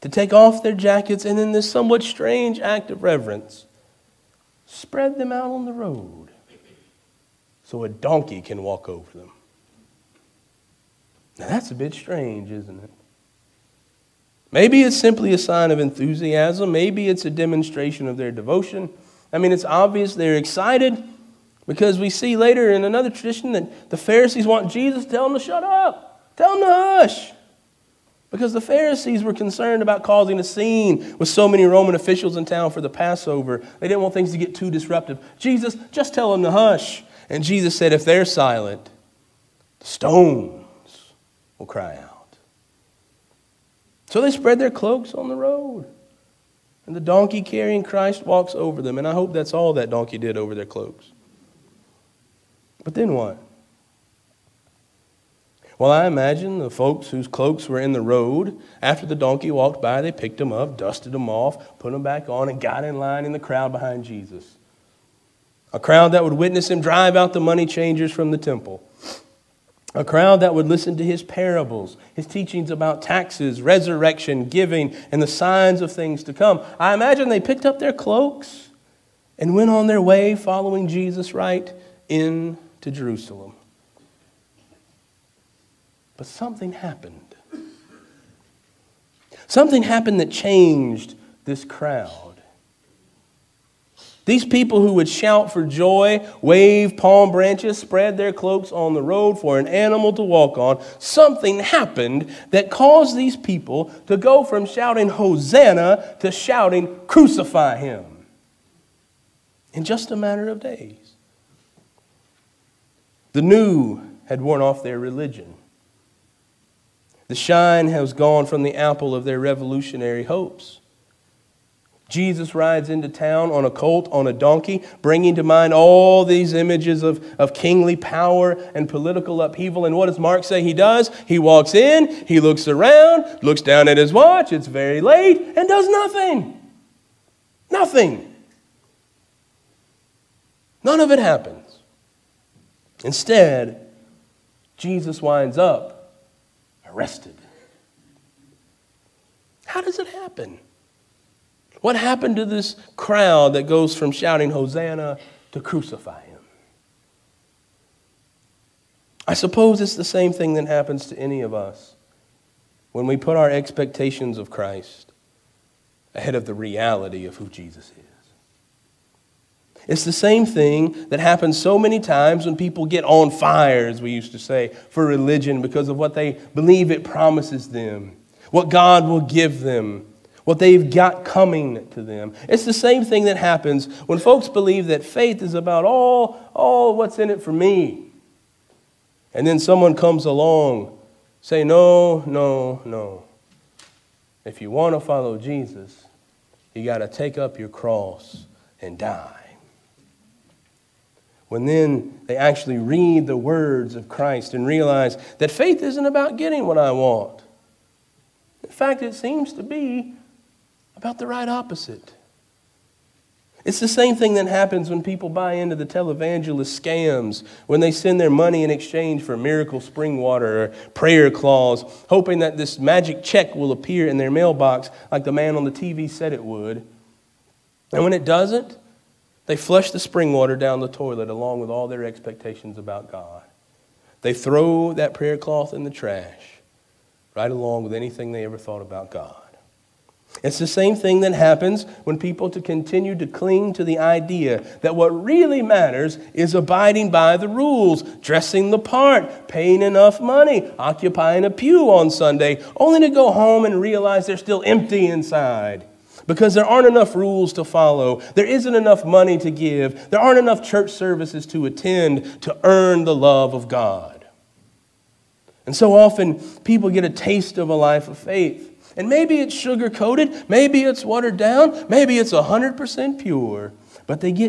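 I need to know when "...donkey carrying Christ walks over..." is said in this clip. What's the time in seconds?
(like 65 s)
46 s.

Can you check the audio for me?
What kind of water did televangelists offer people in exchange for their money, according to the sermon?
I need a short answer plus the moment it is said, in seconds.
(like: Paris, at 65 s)
Miracle spring water, at 219 s.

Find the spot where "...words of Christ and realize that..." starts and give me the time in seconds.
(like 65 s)
203 s.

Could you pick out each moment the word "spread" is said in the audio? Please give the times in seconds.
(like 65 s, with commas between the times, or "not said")
4 s, 44 s, 97 s.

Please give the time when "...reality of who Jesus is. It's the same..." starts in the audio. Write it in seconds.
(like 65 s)
166 s.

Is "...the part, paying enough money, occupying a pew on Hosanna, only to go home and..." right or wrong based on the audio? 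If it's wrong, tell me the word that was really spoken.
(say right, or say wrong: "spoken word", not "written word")
wrong: "Sunday", not "Hosanna".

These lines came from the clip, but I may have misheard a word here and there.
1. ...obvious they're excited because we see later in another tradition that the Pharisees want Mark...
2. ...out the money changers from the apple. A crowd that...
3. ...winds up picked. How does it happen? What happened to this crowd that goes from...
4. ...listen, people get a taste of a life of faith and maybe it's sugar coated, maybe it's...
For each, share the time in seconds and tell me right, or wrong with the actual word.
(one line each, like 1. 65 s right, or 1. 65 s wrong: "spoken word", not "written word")
1. 19 s wrong: "Jesus", not "Mark"
2. 67 s wrong: "temple", not "apple"
3. 145 s wrong: "arrested", not "picked"
4. 265 s wrong: "often", not "listen".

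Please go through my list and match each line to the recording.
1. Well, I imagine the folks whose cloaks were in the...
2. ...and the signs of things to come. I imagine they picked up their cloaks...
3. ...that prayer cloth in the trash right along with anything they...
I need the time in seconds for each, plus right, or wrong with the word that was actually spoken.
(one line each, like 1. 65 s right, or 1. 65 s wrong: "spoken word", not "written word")
1. 55 s right
2. 75 s right
3. 234 s right.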